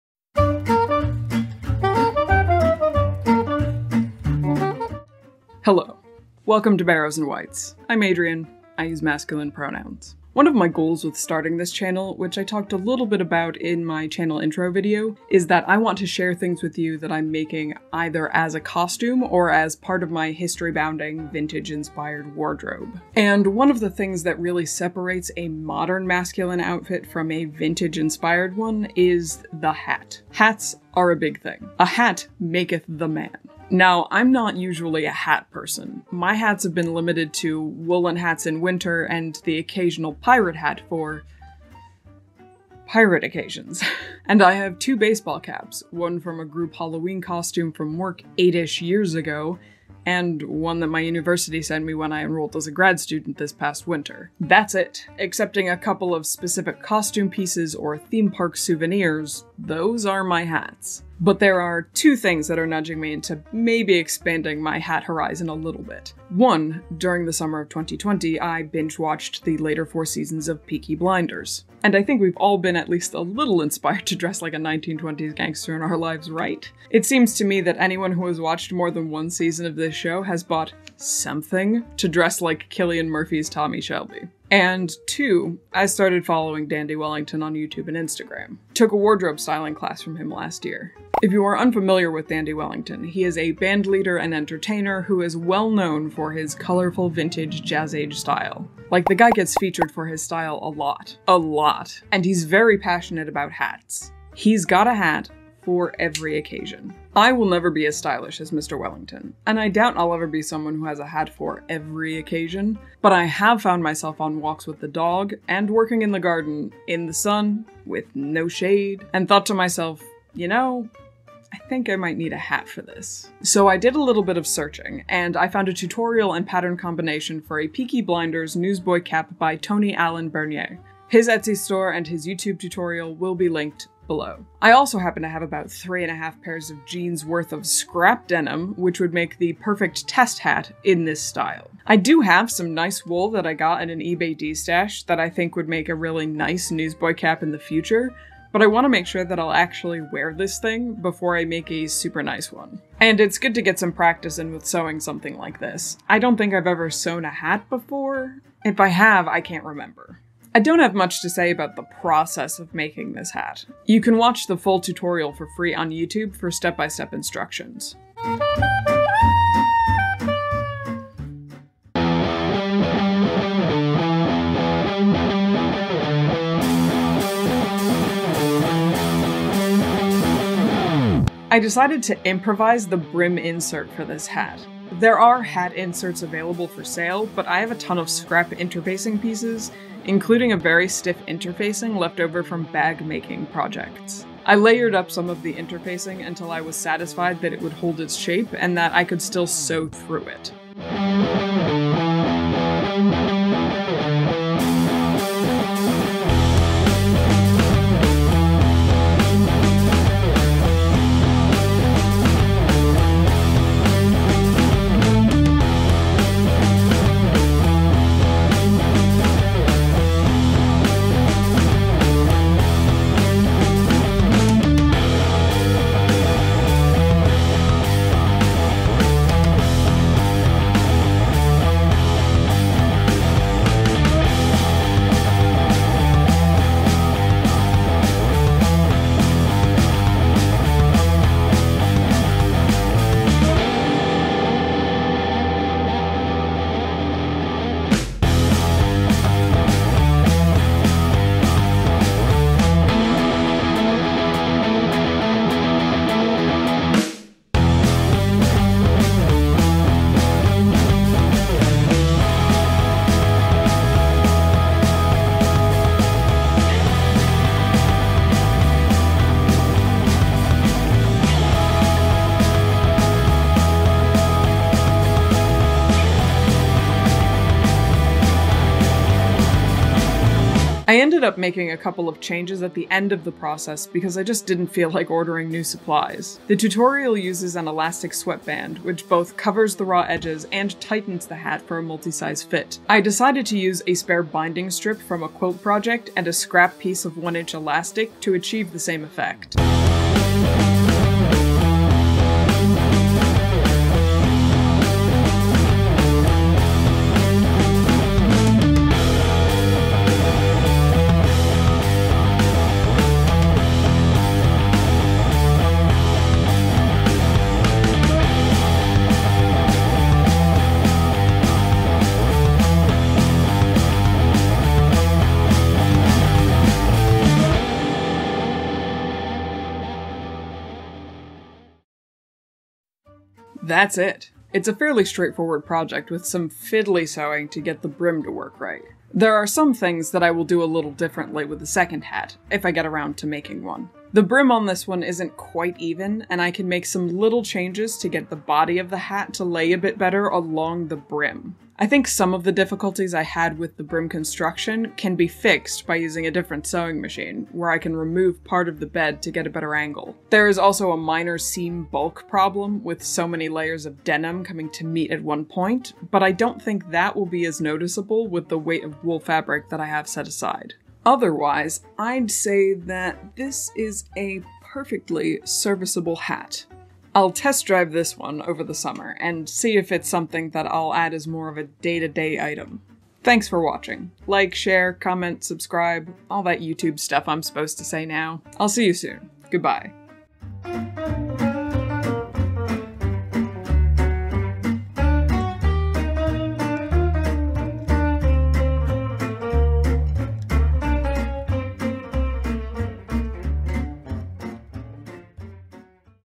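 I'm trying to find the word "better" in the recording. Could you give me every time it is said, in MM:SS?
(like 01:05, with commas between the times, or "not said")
05:49, 05:59.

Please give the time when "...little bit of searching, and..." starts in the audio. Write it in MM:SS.
02:04.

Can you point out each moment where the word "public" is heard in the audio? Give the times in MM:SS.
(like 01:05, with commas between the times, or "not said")
not said.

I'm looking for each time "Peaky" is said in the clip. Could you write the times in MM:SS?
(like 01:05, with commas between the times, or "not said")
01:10, 02:07.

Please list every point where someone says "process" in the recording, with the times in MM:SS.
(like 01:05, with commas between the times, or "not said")
02:42, 04:43.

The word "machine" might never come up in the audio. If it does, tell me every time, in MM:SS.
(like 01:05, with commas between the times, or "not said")
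05:56.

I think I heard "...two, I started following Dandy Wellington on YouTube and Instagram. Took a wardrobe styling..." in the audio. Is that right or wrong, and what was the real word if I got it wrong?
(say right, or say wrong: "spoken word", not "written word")
right.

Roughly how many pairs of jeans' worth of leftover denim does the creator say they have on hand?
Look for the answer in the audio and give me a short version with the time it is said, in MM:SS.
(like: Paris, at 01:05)
3 and a half, at 02:15.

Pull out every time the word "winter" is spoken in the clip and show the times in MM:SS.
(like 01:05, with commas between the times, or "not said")
00:38, 00:53.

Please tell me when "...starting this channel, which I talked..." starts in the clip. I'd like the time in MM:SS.
00:11.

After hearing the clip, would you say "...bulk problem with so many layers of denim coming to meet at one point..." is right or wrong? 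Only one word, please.
right.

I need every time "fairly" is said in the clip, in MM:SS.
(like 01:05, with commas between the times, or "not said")
05:34.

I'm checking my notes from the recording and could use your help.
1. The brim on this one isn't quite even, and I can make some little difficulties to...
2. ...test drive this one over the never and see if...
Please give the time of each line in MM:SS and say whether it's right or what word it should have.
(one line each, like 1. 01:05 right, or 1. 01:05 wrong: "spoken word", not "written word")
1. 05:44 wrong: "changes", not "difficulties"
2. 06:17 wrong: "summer", not "never".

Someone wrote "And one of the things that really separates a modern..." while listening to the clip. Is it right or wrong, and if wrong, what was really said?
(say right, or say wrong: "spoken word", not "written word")
right.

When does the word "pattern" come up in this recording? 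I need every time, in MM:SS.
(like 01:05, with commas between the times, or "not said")
02:06.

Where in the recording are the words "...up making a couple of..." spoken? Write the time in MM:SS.
04:41.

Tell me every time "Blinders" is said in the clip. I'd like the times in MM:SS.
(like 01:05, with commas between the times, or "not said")
01:10, 02:08.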